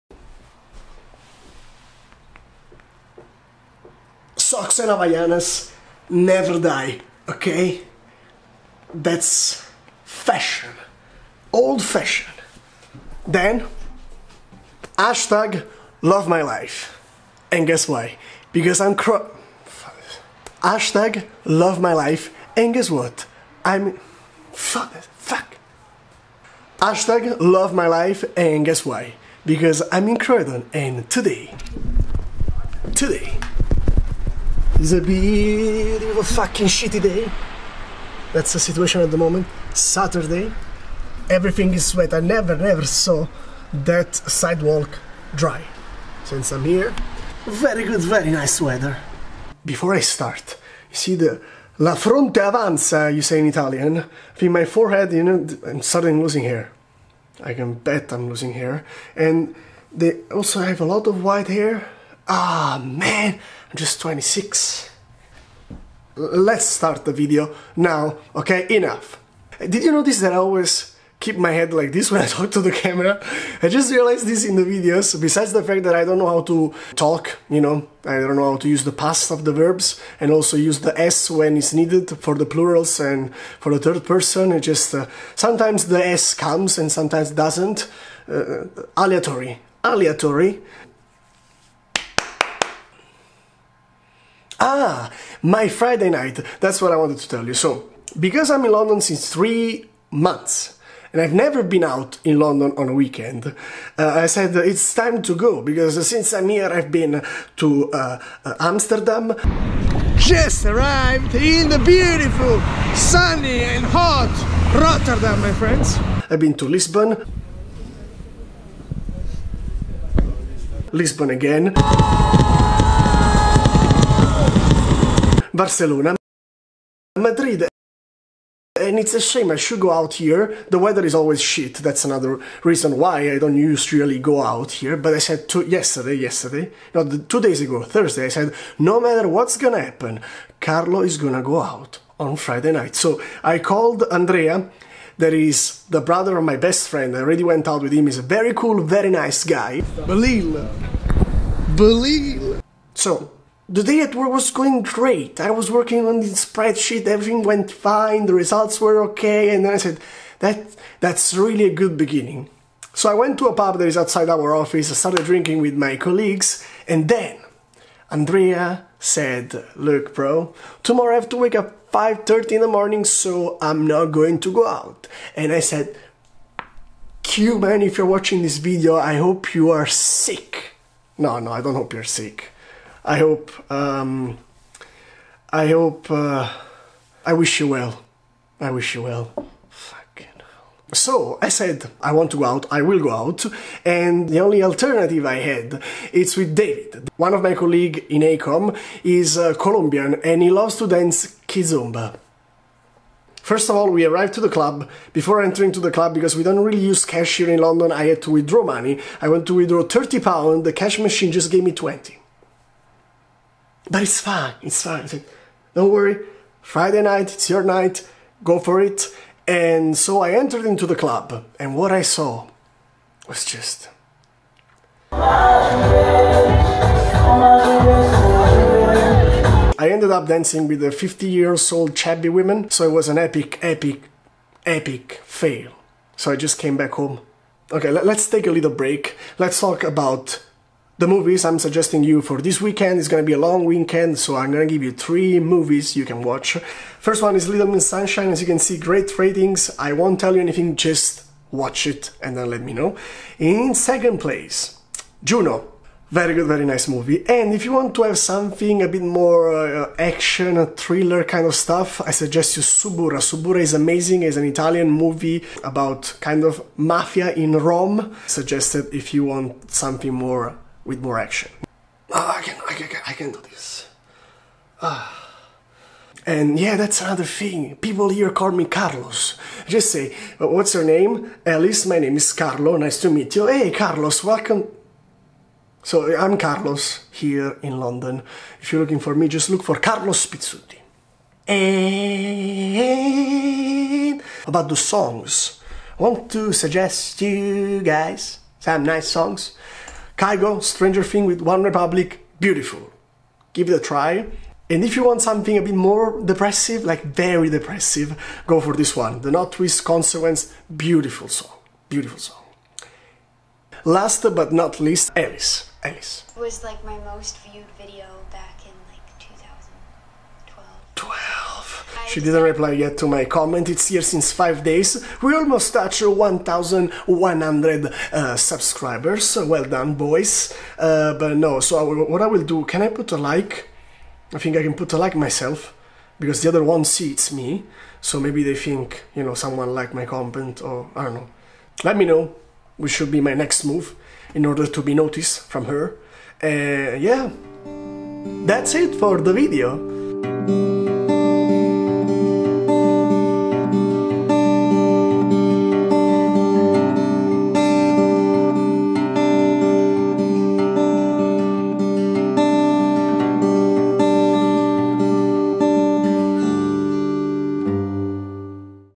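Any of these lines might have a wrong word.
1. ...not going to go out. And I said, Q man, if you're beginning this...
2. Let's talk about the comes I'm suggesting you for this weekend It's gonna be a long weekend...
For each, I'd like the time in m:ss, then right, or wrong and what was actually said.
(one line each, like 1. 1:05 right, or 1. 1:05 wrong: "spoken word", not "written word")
1. 2:53 wrong: "watching", not "beginning"
2. 3:59 wrong: "movies", not "comes".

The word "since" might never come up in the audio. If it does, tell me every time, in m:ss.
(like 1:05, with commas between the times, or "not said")
0:46, 1:39, 1:46, 5:24.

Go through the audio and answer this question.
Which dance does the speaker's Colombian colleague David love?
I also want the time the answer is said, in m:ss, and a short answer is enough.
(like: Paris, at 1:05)
kizomba, at 3:21.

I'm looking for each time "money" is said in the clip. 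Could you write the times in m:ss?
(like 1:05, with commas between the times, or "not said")
3:28.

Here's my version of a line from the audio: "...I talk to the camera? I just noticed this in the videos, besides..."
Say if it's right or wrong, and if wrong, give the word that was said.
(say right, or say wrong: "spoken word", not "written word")
wrong: "realized", not "noticed".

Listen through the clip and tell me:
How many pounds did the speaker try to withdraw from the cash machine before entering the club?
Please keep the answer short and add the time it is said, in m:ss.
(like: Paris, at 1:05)
30, at 3:29.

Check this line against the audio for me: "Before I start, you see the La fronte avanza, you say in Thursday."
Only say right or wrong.
wrong.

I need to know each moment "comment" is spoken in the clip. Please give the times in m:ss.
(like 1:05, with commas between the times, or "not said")
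5:23, 5:40.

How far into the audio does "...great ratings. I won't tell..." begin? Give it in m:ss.
4:08.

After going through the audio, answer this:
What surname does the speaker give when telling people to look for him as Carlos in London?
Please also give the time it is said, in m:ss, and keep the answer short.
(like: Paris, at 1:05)
Pizzuti, at 4:50.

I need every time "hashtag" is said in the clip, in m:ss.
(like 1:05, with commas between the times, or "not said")
0:14, 0:20, 0:26.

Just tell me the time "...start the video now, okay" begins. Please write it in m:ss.
1:06.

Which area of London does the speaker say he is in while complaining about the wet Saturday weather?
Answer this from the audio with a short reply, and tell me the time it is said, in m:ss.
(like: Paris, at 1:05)
Croydon, at 0:30.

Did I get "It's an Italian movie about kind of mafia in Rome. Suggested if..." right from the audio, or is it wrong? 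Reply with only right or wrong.
right.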